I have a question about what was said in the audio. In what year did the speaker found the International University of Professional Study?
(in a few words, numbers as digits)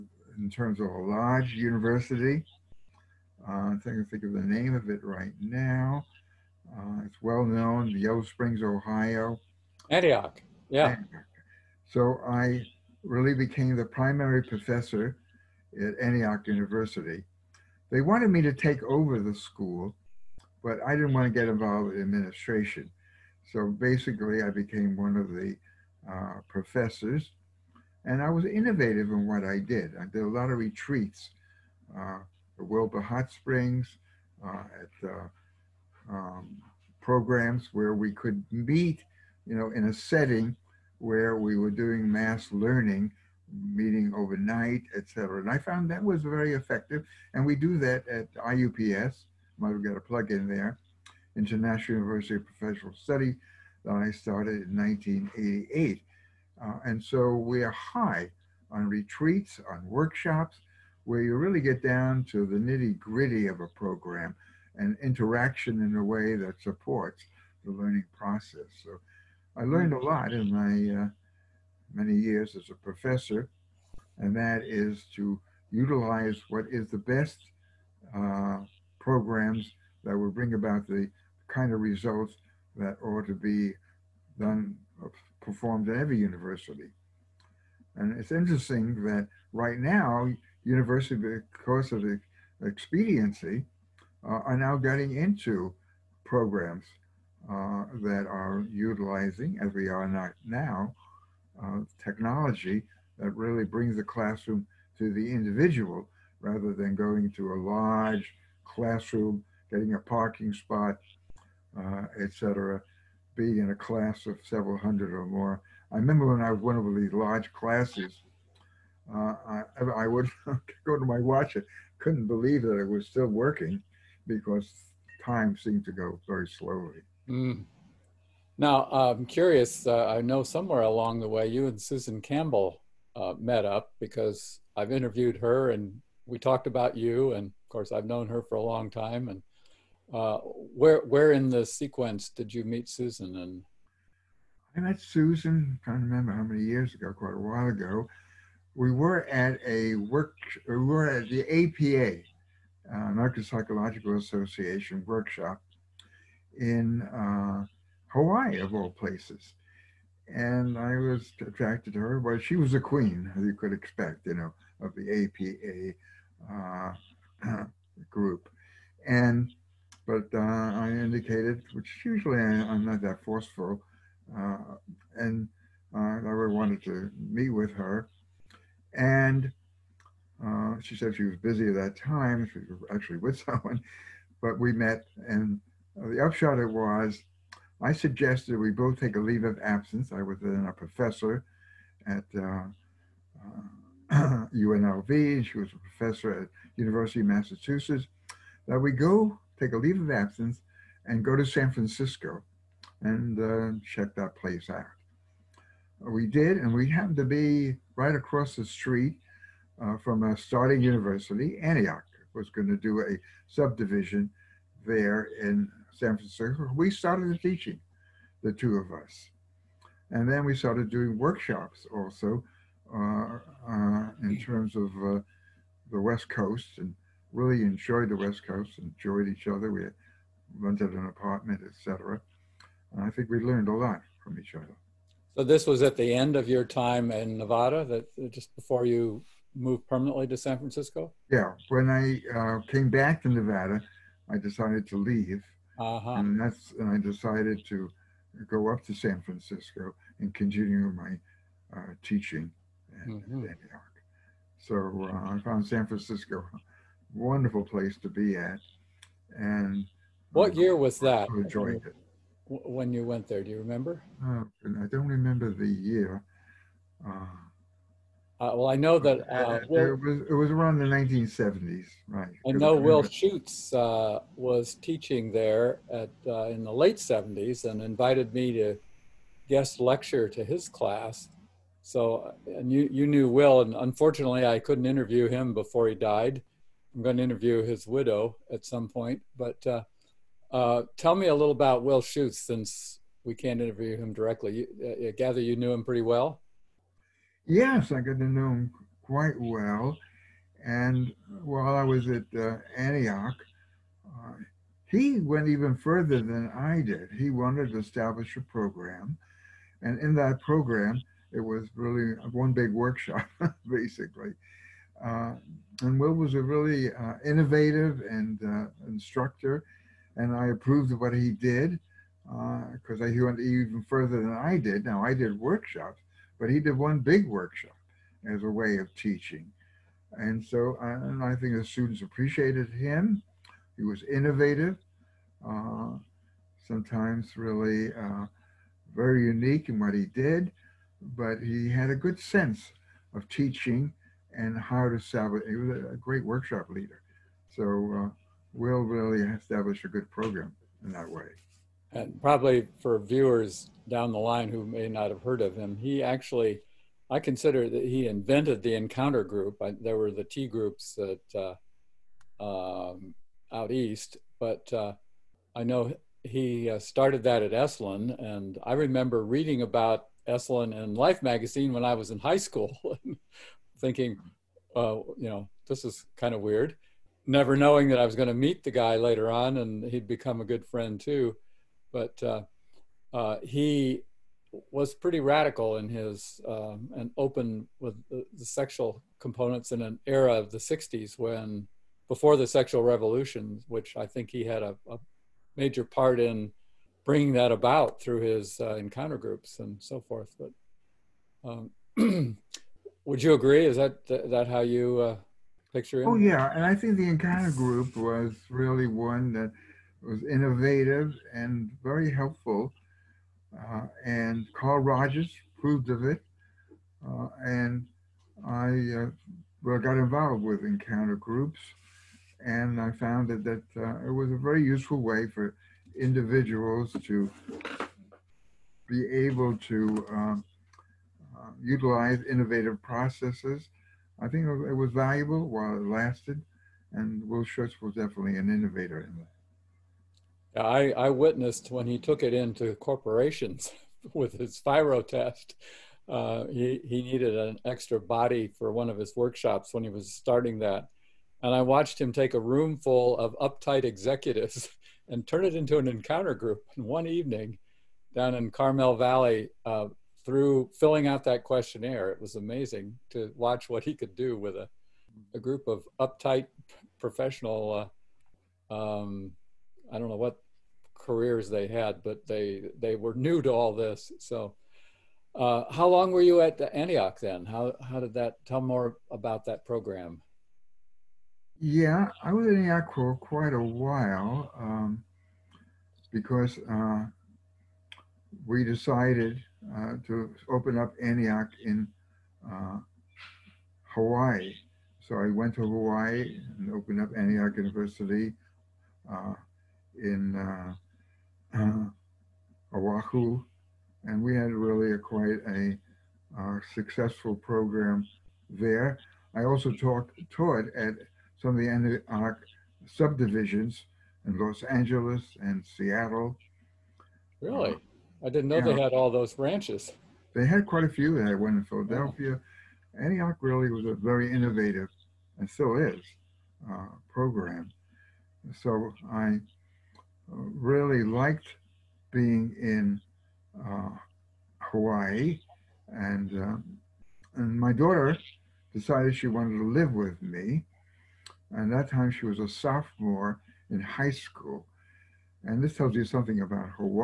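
1988.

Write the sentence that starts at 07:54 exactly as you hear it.
So uh, how long were you at Antioch then?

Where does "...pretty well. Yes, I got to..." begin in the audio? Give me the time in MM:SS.
04:55.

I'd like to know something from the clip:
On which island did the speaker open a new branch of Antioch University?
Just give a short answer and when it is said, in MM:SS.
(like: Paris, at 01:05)
Oahu, at 08:22.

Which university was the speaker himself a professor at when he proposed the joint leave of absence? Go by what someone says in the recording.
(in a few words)
UNLV.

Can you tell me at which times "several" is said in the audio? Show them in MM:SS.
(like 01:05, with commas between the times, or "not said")
01:54.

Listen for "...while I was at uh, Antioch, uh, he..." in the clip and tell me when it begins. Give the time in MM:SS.
05:01.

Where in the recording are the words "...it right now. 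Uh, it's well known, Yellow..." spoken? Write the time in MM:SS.
00:04.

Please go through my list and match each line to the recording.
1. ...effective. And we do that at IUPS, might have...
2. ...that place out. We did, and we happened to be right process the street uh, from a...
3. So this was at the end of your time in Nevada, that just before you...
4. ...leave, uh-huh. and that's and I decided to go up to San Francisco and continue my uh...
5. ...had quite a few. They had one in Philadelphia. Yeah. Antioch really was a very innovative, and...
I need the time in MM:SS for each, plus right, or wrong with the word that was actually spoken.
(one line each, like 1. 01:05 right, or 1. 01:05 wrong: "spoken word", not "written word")
1. 00:46 right
2. 03:24 wrong: "across", not "process"
3. 03:55 right
4. 04:04 right
5. 08:40 right.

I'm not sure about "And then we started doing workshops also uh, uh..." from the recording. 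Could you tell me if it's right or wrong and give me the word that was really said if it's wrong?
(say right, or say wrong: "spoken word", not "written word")
right.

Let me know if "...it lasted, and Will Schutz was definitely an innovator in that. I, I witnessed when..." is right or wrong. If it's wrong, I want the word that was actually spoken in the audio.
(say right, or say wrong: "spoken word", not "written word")
right.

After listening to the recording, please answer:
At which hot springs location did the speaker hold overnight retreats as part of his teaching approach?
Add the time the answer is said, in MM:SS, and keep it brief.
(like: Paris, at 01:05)
Wilbur Hot Springs, at 00:32.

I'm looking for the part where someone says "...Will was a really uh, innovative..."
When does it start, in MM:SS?
05:15.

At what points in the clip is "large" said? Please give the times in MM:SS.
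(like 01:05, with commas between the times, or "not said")
00:01, 01:47, 01:57.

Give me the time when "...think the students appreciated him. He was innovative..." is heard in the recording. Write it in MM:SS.
05:31.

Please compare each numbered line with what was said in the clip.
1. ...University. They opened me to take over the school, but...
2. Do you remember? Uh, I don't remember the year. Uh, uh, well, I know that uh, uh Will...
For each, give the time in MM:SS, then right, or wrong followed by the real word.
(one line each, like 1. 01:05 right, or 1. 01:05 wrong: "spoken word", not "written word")
1. 00:16 wrong: "wanted", not "opened"
2. 04:23 right.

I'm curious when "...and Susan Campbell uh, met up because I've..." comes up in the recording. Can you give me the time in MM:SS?
02:11.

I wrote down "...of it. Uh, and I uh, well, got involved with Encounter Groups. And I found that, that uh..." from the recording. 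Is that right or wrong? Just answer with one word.
right.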